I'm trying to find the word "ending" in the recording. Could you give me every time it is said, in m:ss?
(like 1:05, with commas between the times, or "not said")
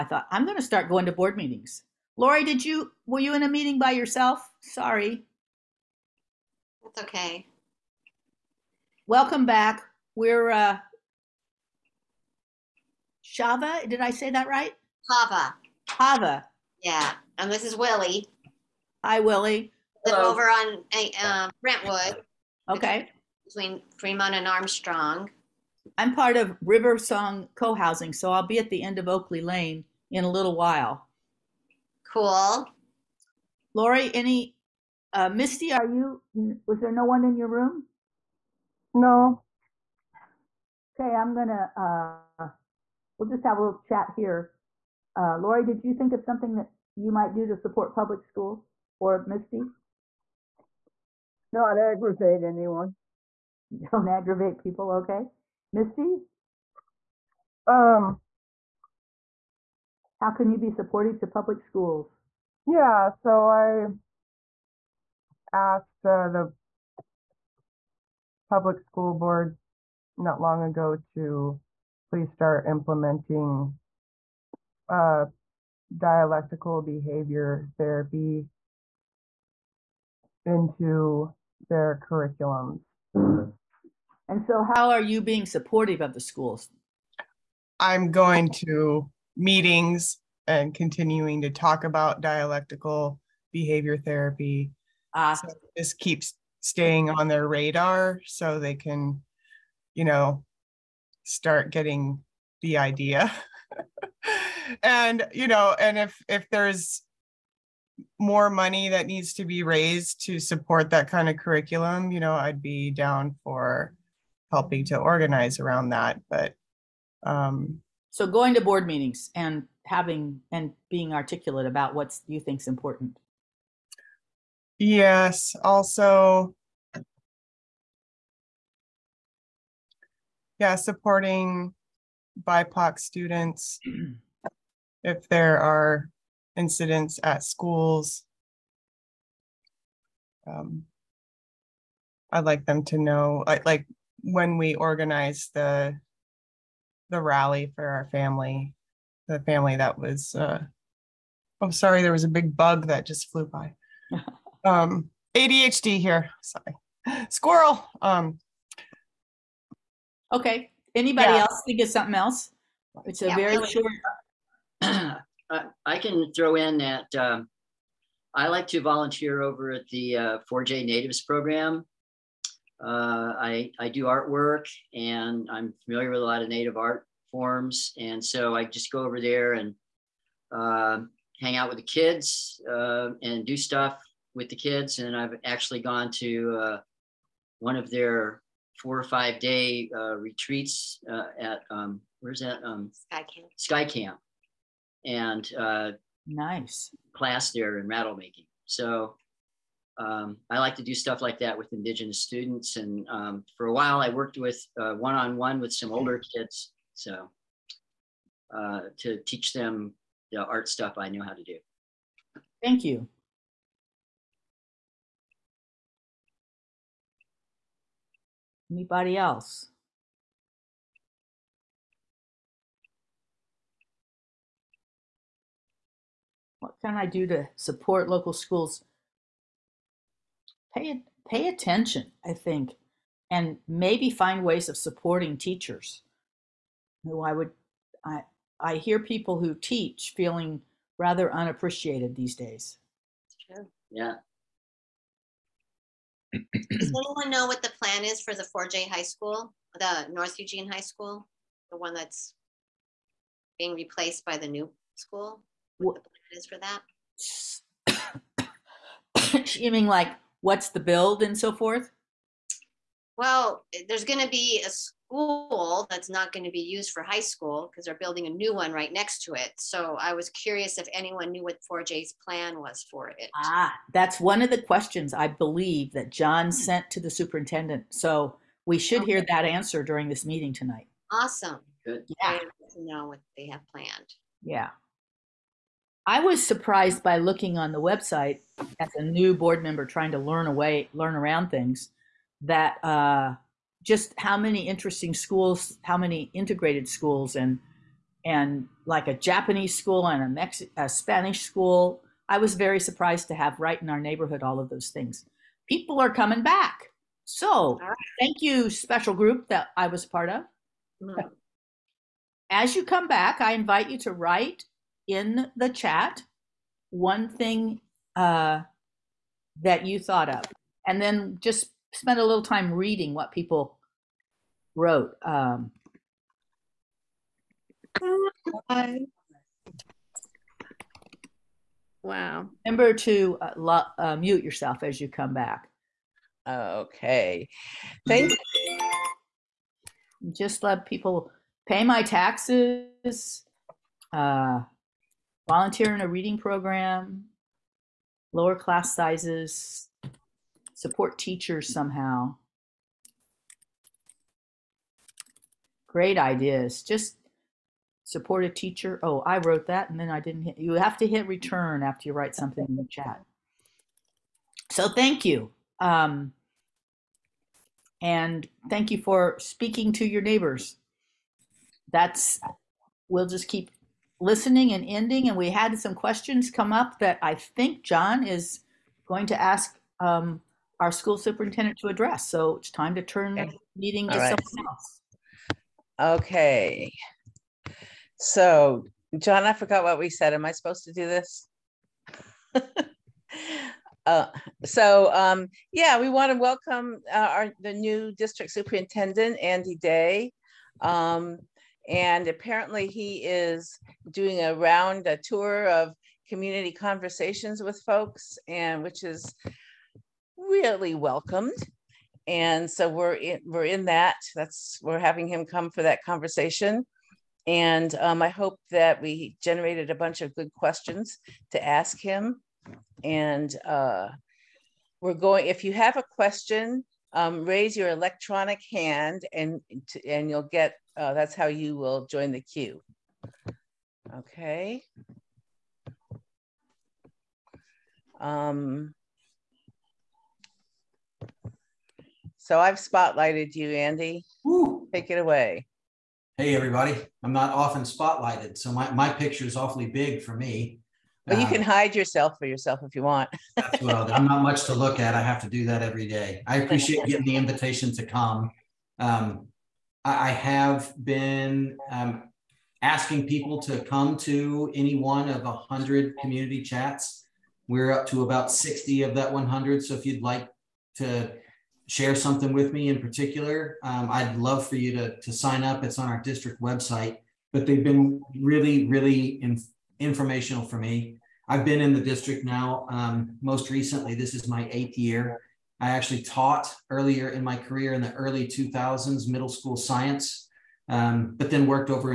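6:14.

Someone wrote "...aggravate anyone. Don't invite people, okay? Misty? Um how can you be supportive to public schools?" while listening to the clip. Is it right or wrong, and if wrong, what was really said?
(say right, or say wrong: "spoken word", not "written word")
wrong: "aggravate", not "invite".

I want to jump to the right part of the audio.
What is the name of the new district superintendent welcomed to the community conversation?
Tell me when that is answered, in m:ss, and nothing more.
6:39.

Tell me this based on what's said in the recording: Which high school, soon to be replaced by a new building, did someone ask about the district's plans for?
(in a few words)
North Eugene High School.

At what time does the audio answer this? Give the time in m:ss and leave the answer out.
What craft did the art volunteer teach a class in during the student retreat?
3:17.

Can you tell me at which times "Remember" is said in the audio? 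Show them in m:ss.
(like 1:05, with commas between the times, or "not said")
5:32.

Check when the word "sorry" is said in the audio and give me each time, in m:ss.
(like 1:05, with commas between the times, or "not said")
0:04, 2:31, 2:36.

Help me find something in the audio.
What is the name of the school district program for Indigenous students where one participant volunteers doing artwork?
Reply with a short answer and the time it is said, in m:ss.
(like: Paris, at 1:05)
4J Natives, at 2:50.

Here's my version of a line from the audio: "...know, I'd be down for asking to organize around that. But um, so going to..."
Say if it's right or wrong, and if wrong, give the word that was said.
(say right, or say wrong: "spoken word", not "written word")
wrong: "helping", not "asking".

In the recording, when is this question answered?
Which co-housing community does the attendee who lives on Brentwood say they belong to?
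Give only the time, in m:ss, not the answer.
0:26.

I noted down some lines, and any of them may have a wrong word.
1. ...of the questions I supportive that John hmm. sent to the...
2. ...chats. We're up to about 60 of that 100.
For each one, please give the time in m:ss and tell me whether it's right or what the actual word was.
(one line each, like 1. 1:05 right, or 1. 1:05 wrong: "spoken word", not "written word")
1. 4:34 wrong: "believe", not "supportive"
2. 7:46 right.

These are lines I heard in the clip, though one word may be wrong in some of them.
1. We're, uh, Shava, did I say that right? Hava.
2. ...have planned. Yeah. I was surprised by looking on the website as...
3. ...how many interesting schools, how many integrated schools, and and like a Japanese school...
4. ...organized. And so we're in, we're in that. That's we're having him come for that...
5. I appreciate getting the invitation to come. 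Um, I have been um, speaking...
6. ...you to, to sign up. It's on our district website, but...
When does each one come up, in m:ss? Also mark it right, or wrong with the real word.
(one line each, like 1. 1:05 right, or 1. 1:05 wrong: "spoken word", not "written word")
1. 0:10 right
2. 4:43 right
3. 4:54 right
4. 6:50 wrong: "welcomed", not "organized"
5. 7:36 wrong: "asking", not "speaking"
6. 7:54 right.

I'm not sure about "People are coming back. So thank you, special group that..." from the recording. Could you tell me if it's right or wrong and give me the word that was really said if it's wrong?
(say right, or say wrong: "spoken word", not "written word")
right.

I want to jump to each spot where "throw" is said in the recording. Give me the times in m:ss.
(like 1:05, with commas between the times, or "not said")
2:46.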